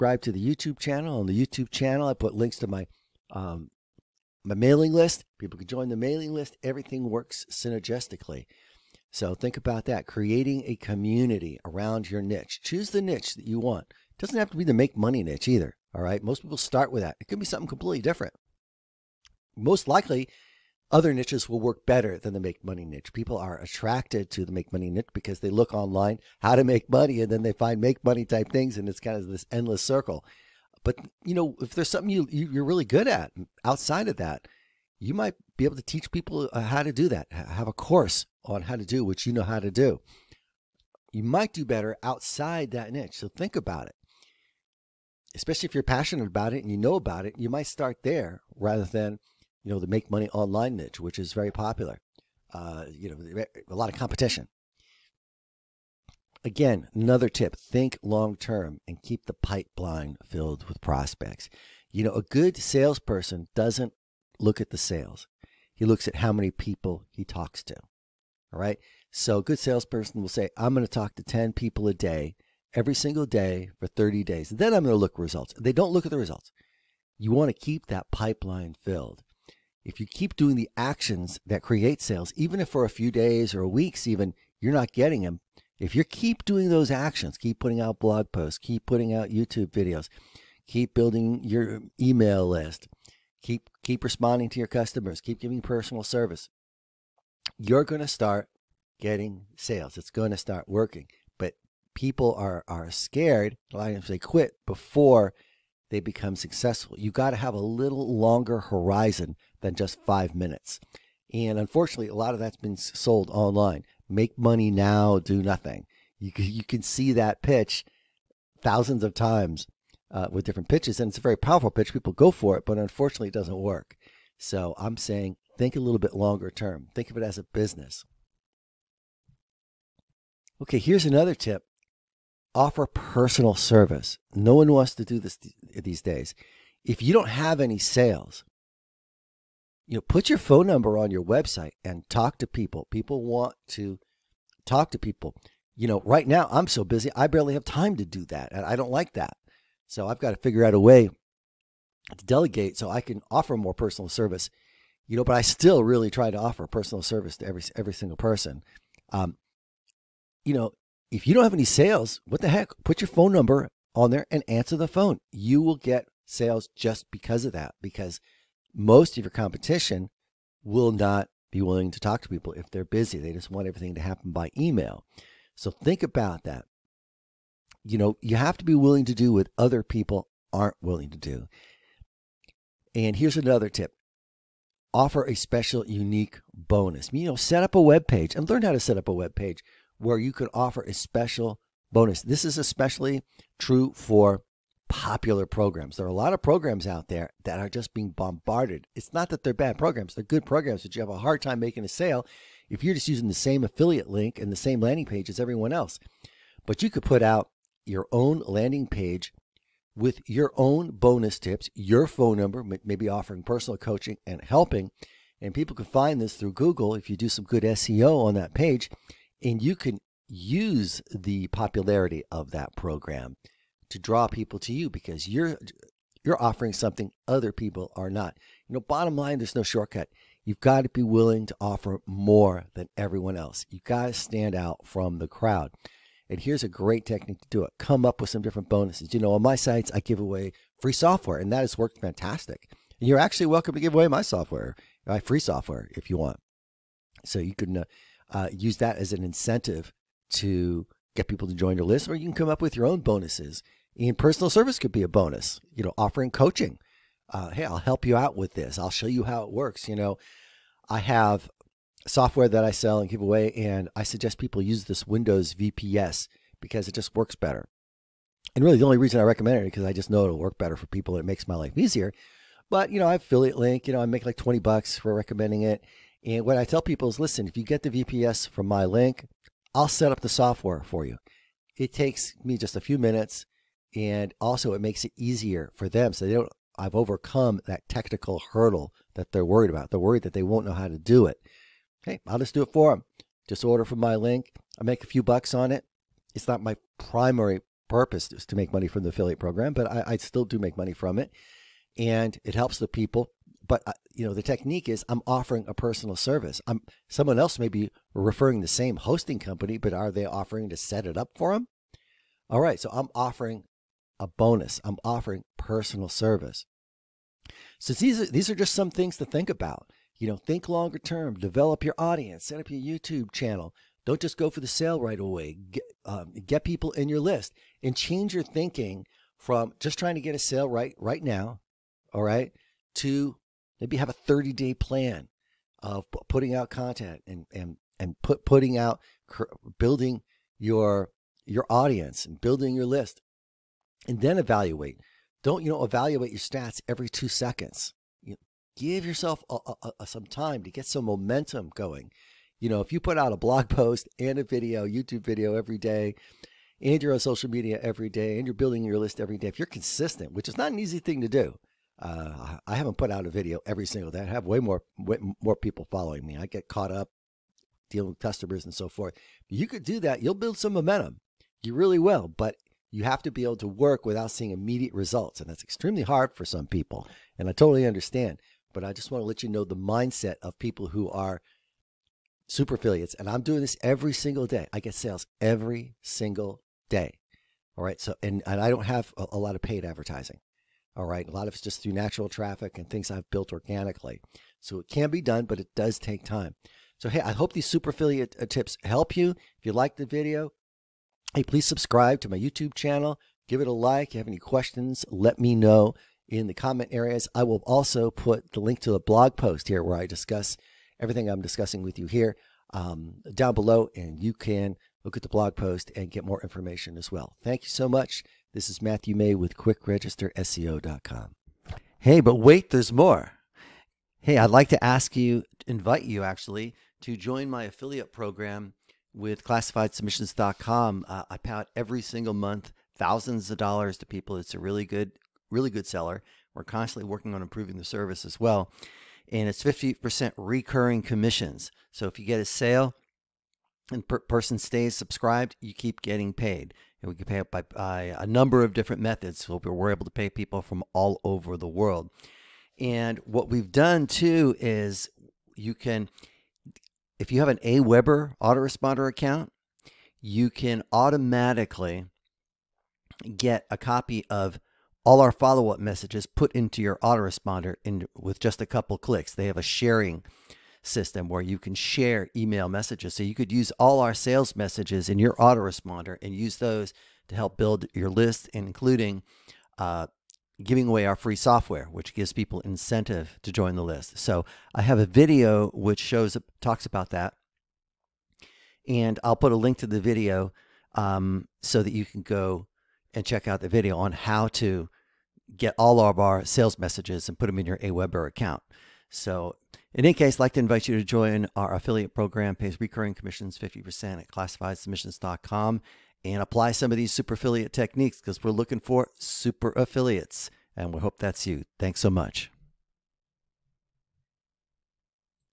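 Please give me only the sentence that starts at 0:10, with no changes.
Creating a community around your niche.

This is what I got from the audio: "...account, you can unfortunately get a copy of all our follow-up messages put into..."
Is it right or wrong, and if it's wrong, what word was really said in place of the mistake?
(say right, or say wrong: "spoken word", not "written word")
wrong: "automatically", not "unfortunately".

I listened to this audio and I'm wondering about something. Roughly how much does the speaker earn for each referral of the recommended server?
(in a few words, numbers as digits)
$20.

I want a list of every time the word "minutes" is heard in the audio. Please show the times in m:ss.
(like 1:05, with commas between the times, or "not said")
1:50, 4:42.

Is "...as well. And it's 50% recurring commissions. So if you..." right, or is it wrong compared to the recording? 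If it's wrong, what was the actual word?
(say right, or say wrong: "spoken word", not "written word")
right.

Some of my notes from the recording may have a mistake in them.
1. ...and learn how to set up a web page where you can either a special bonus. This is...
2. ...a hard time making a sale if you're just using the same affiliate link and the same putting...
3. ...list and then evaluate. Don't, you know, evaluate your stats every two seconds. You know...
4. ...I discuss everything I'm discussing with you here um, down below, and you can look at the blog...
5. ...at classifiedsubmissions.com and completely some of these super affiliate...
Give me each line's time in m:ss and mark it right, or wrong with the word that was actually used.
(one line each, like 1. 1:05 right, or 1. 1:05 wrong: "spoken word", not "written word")
1. 3:08 wrong: "offer", not "either"
2. 3:21 wrong: "landing", not "putting"
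3. 5:42 right
4. 6:49 right
5. 8:24 wrong: "apply", not "completely".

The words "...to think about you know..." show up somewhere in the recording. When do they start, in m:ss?
5:19.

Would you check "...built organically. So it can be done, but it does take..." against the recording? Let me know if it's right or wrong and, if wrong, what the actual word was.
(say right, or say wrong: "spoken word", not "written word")
right.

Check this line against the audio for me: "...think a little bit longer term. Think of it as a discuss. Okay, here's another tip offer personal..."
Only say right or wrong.
wrong.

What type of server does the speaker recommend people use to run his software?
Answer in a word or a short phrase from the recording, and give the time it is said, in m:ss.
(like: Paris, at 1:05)
Windows VPS, at 4:25.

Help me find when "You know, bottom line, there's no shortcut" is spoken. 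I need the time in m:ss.
3:48.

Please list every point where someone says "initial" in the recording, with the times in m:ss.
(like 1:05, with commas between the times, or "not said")
not said.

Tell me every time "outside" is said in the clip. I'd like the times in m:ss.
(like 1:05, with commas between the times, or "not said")
0:33, 0:42.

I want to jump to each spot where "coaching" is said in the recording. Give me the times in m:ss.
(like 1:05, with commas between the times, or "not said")
3:33, 4:16.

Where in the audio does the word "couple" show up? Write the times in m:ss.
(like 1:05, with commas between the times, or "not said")
7:48.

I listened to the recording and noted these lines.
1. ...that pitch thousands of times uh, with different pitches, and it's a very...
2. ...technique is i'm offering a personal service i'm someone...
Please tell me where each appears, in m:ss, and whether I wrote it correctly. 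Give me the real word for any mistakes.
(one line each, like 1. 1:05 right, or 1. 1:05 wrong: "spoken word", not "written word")
1. 1:57 right
2. 5:04 right.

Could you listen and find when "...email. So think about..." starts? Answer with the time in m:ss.
2:54.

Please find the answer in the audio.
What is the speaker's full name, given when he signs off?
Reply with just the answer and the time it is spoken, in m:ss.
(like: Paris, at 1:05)
Matthew May, at 6:58.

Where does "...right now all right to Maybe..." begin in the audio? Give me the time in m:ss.
5:30.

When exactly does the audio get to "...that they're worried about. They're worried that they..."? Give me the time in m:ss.
4:49.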